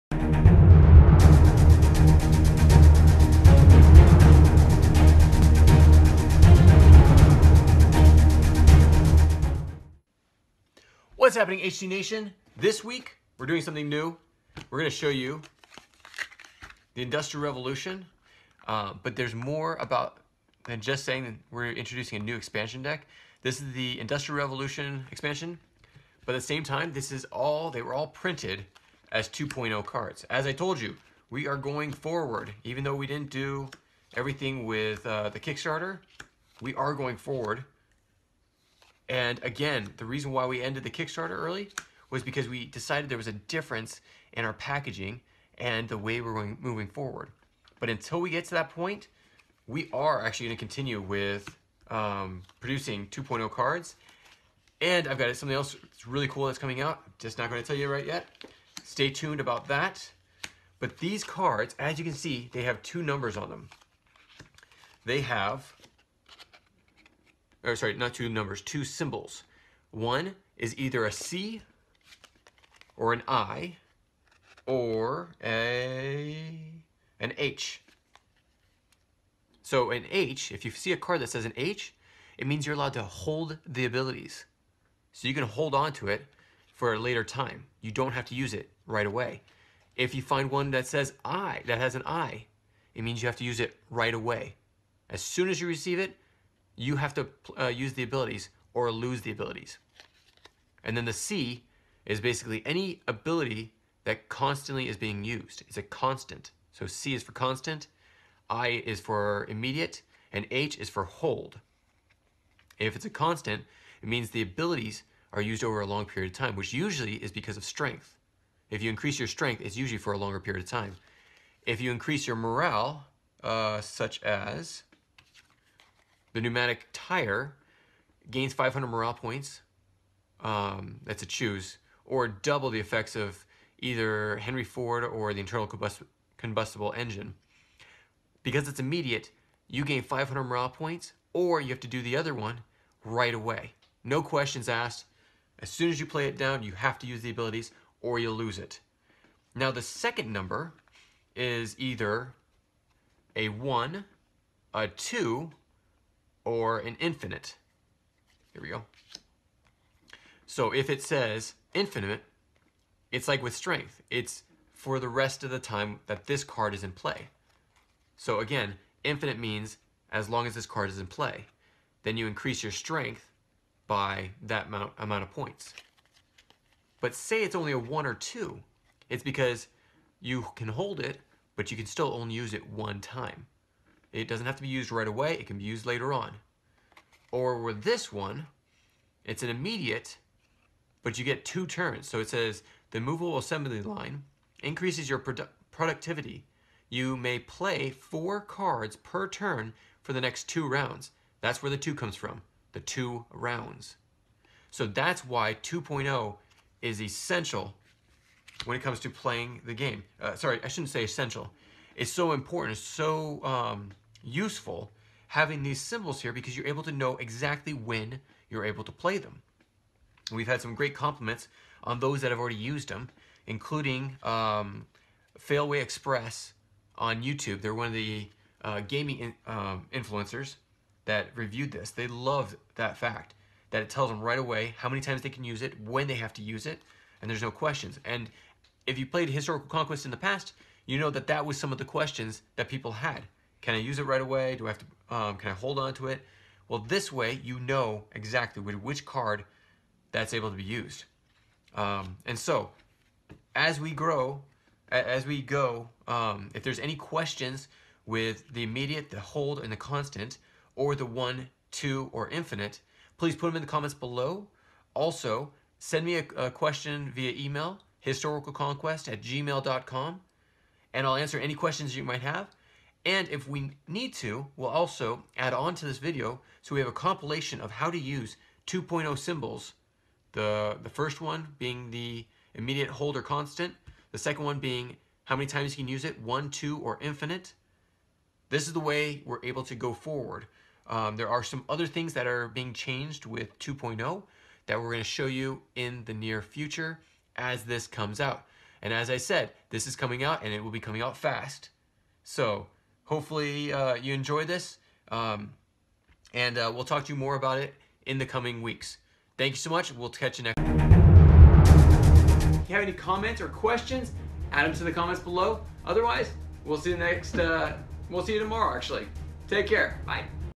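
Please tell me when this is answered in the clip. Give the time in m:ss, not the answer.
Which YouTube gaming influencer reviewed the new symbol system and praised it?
3:45.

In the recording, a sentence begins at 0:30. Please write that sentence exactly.
As I told you, we are going forward.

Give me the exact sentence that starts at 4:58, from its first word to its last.
And as I said, this is coming out and it will be coming out fast.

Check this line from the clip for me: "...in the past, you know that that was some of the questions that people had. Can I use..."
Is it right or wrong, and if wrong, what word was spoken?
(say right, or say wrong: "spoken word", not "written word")
right.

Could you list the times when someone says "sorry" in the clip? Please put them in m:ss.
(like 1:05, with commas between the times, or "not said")
1:07, 3:30.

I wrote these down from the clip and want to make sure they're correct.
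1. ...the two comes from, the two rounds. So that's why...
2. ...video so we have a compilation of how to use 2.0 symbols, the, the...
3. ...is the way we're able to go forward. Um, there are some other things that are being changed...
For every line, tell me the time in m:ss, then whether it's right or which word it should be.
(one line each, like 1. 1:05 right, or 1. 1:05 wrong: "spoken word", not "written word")
1. 3:21 right
2. 4:35 right
3. 4:48 right.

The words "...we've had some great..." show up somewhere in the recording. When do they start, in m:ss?
3:40.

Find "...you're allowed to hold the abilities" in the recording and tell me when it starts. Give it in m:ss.
1:22.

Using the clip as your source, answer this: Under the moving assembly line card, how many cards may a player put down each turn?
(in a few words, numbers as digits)
4.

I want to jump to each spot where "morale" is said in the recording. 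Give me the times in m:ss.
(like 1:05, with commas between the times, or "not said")
2:02, 2:08, 2:20.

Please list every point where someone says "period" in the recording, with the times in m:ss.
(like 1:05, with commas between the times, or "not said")
1:56, 2:00.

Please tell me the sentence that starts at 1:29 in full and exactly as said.
If you find one that says I, that has an I, it means you have to use it right away.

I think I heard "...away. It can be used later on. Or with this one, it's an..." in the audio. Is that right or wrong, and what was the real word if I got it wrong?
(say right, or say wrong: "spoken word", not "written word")
right.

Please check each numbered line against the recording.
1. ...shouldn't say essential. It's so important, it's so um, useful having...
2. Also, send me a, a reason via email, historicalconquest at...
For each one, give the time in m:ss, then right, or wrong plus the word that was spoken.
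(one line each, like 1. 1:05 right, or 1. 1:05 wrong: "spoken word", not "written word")
1. 3:30 right
2. 4:24 wrong: "question", not "reason".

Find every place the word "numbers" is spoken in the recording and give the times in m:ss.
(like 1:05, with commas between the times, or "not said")
1:03, 1:08, 2:30.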